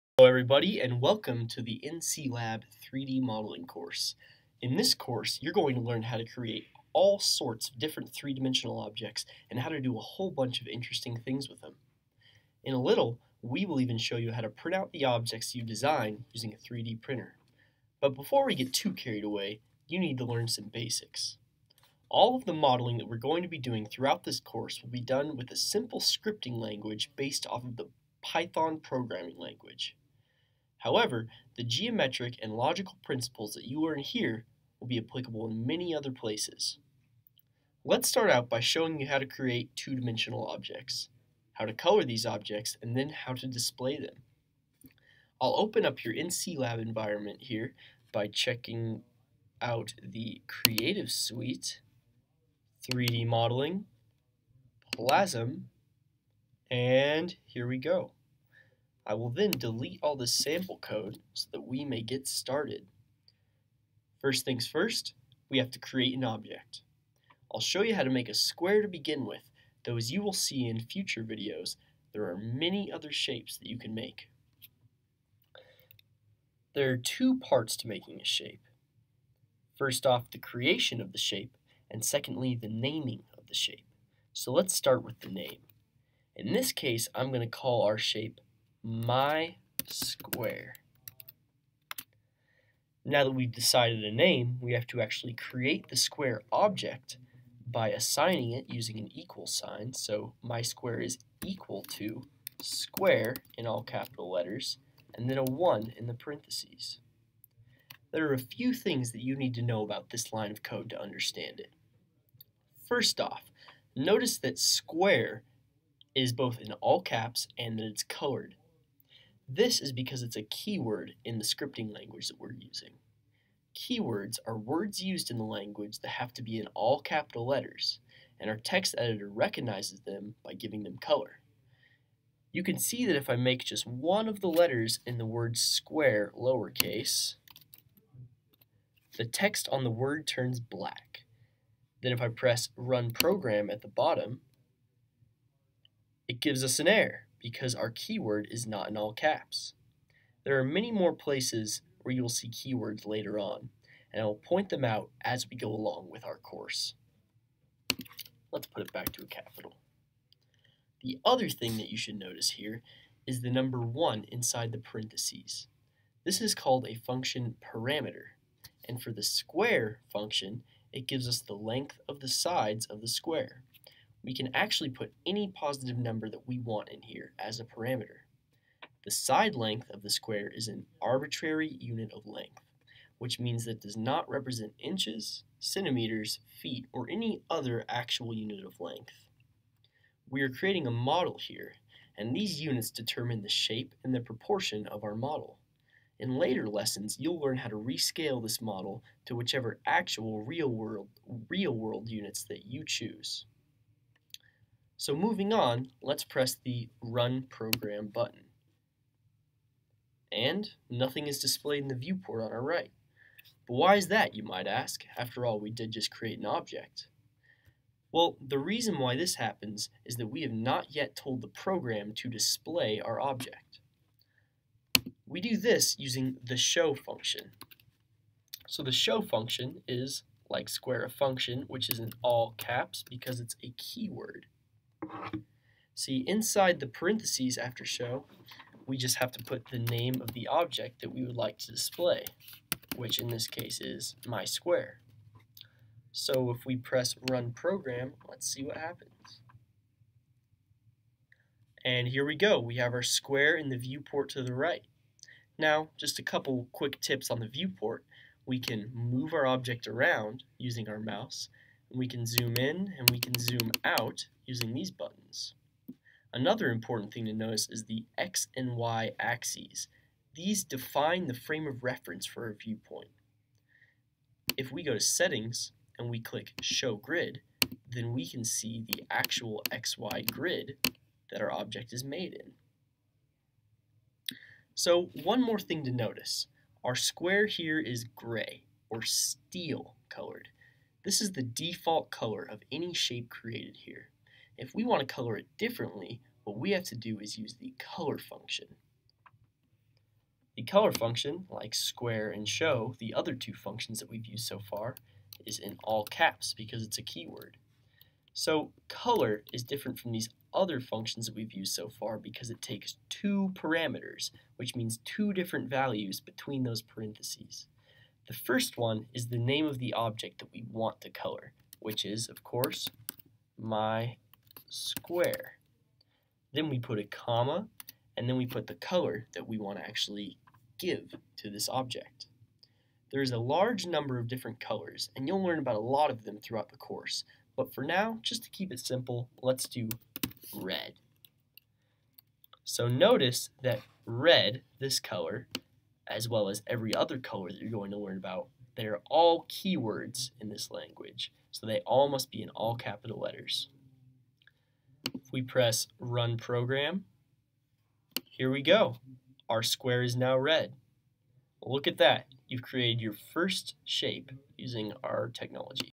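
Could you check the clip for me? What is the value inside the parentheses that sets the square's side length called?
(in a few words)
function parameter.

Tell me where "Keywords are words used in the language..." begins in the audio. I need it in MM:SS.
02:03.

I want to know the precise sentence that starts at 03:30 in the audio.
And nothing is displayed in the viewport on our right.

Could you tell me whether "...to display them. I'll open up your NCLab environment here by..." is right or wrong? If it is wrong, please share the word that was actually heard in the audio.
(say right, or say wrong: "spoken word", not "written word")
right.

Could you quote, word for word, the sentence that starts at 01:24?
So let's start with the name.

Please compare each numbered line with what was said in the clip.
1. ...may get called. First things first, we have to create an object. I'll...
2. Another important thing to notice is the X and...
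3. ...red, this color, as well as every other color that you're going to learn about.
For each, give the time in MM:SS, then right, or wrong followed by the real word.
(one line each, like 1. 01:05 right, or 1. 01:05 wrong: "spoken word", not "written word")
1. 01:01 wrong: "started", not "called"
2. 04:26 right
3. 05:44 right.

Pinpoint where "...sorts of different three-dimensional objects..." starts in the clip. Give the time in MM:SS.
00:07.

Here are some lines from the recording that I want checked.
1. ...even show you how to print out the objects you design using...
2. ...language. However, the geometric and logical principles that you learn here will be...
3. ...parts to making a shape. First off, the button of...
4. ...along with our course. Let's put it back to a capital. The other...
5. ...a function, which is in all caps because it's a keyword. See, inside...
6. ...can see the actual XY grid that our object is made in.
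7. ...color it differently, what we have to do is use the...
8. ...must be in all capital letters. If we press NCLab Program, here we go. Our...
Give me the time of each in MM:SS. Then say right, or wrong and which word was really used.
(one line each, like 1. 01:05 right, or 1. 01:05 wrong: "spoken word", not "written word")
1. 00:13 right
2. 00:29 right
3. 01:17 wrong: "creation", not "button"
4. 02:35 right
5. 03:51 right
6. 04:38 right
7. 04:55 right
8. 05:52 wrong: "Run", not "NCLab".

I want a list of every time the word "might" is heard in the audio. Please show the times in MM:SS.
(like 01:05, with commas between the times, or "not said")
03:34.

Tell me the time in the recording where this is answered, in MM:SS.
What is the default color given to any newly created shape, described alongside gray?
04:49.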